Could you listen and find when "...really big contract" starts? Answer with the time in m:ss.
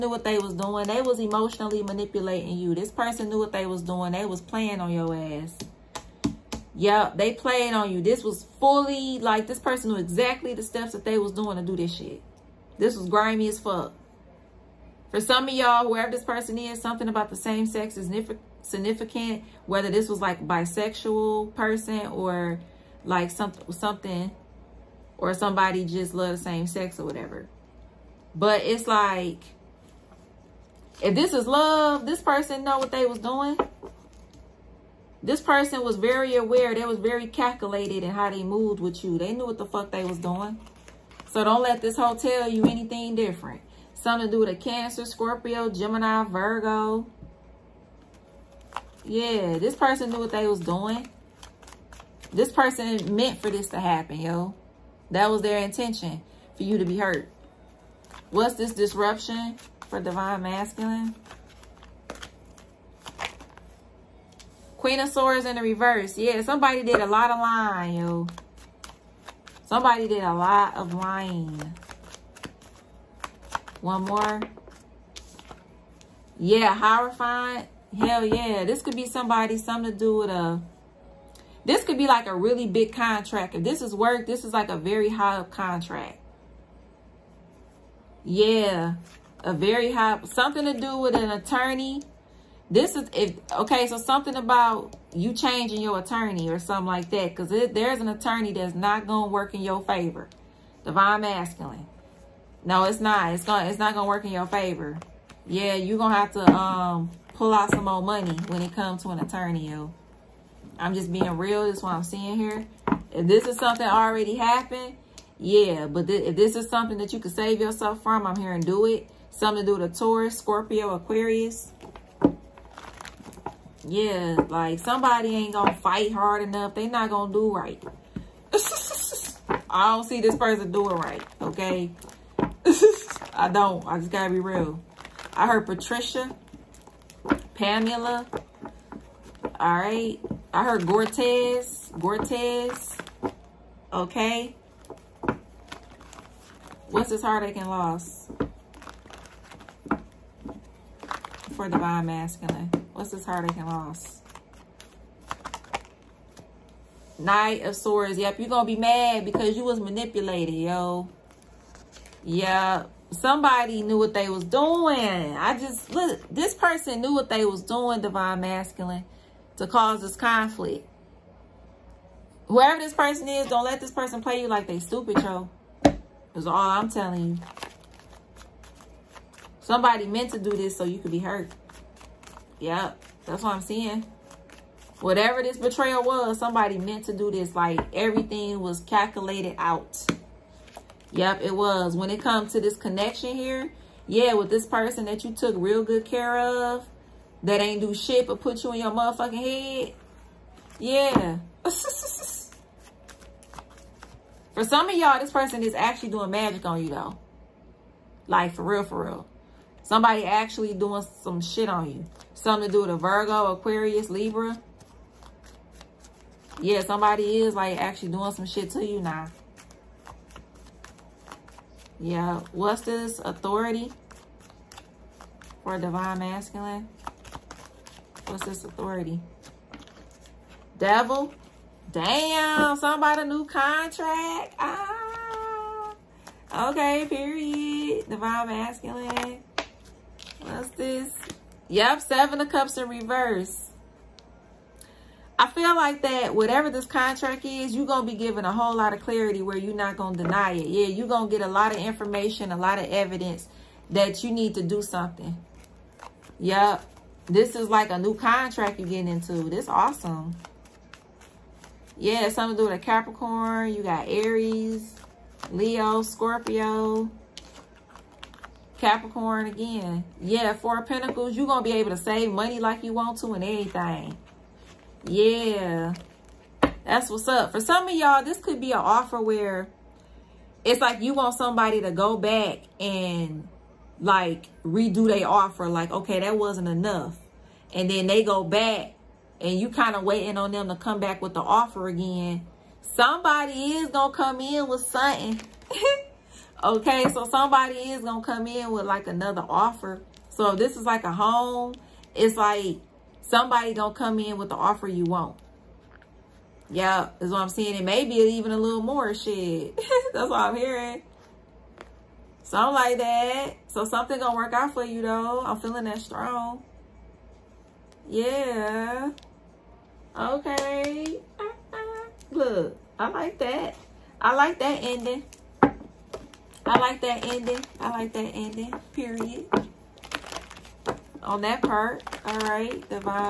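1:22.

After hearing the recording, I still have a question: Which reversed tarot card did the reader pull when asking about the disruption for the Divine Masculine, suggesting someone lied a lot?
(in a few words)
Queen of Swords.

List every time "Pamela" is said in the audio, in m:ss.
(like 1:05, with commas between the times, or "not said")
2:17.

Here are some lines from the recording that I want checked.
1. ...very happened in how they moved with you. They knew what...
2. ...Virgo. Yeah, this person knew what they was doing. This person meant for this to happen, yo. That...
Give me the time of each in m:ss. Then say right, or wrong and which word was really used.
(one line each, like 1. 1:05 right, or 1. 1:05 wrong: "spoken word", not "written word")
1. 0:36 wrong: "calculated", not "happened"
2. 0:46 right.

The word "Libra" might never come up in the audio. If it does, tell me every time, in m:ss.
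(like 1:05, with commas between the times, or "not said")
3:34.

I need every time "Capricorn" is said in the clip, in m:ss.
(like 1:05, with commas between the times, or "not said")
4:22, 4:28.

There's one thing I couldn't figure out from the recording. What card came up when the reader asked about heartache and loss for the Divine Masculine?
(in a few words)
Knight of Swords.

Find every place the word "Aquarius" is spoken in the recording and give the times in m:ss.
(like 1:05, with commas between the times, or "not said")
2:00, 3:33.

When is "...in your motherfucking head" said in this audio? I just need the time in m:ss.
3:18.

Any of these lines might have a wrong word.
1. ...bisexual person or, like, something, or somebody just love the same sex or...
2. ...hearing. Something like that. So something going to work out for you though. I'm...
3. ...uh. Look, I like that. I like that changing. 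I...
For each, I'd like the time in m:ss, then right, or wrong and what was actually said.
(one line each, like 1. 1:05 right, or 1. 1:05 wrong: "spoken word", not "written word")
1. 0:20 right
2. 5:10 right
3. 5:21 wrong: "ending", not "changing".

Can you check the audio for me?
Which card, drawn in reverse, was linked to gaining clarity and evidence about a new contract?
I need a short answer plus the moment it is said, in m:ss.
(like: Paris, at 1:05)
Seven of Cups, at 4:02.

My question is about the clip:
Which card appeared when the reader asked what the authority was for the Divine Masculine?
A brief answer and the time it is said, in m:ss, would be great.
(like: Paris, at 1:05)
Devil, at 3:50.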